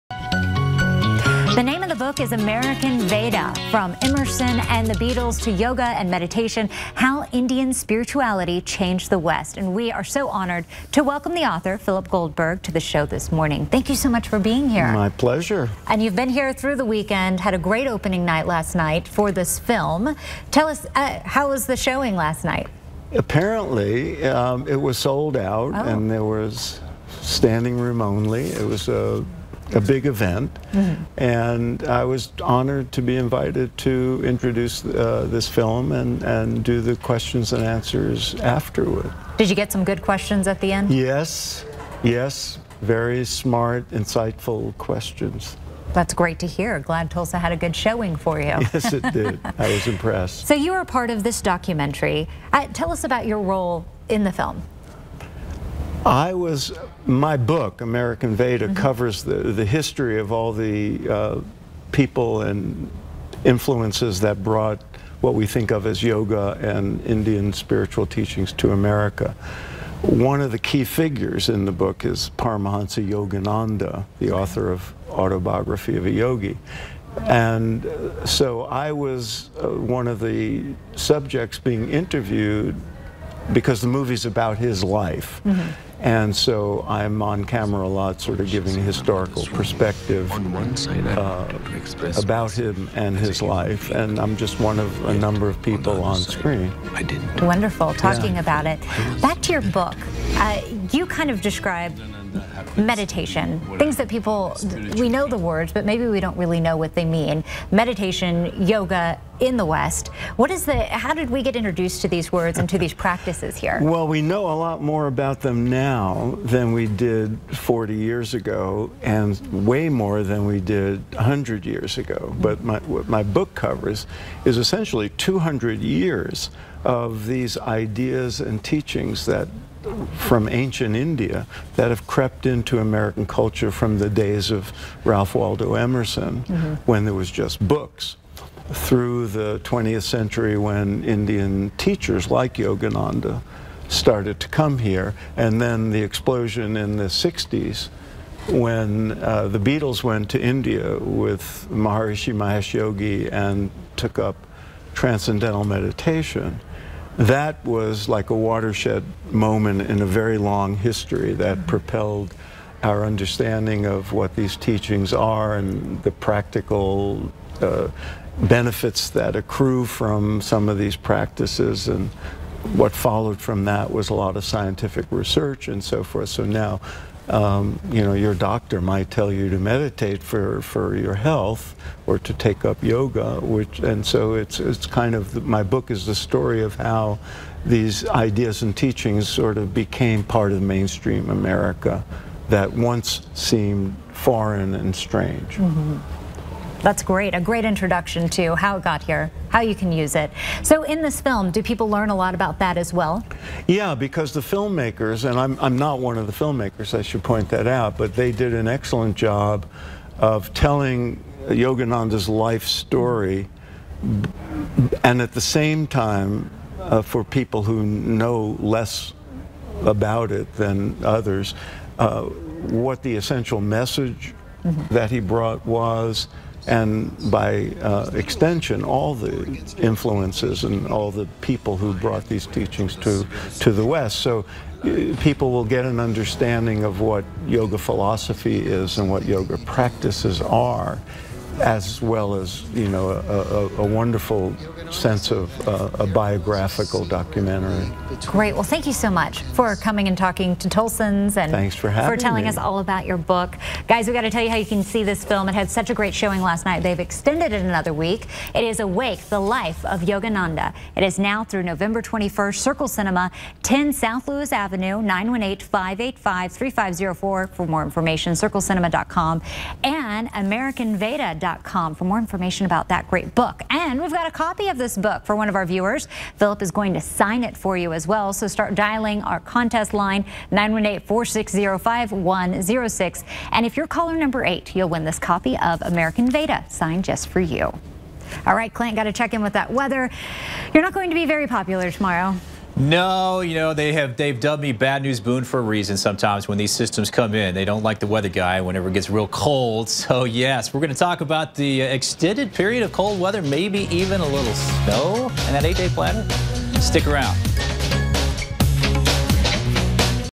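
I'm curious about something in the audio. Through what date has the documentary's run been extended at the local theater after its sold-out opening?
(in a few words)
November 21.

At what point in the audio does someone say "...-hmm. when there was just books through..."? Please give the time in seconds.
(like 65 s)
136 s.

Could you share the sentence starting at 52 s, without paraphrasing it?
Uh, tell us about your role in the film.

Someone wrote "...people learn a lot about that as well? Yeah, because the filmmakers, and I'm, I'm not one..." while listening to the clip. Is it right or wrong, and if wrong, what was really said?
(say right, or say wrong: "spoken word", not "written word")
right.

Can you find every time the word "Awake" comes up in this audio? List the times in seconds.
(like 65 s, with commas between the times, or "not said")
258 s.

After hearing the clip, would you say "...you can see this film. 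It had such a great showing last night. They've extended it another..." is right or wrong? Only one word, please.
right.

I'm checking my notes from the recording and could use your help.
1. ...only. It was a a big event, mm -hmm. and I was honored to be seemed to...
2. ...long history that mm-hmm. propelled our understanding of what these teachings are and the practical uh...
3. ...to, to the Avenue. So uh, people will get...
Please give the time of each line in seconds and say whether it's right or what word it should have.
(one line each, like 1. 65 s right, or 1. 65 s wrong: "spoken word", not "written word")
1. 28 s wrong: "invited", not "seemed"
2. 160 s right
3. 232 s wrong: "West", not "Avenue".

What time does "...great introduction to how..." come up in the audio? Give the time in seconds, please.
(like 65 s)
197 s.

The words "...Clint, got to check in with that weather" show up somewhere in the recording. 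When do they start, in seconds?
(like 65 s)
288 s.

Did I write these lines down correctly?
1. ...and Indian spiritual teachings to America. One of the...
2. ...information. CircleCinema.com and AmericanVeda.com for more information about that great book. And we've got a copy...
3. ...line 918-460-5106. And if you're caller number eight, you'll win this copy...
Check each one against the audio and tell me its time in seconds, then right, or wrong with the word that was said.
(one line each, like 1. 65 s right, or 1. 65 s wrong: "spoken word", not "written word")
1. 66 s right
2. 267 s right
3. 279 s right.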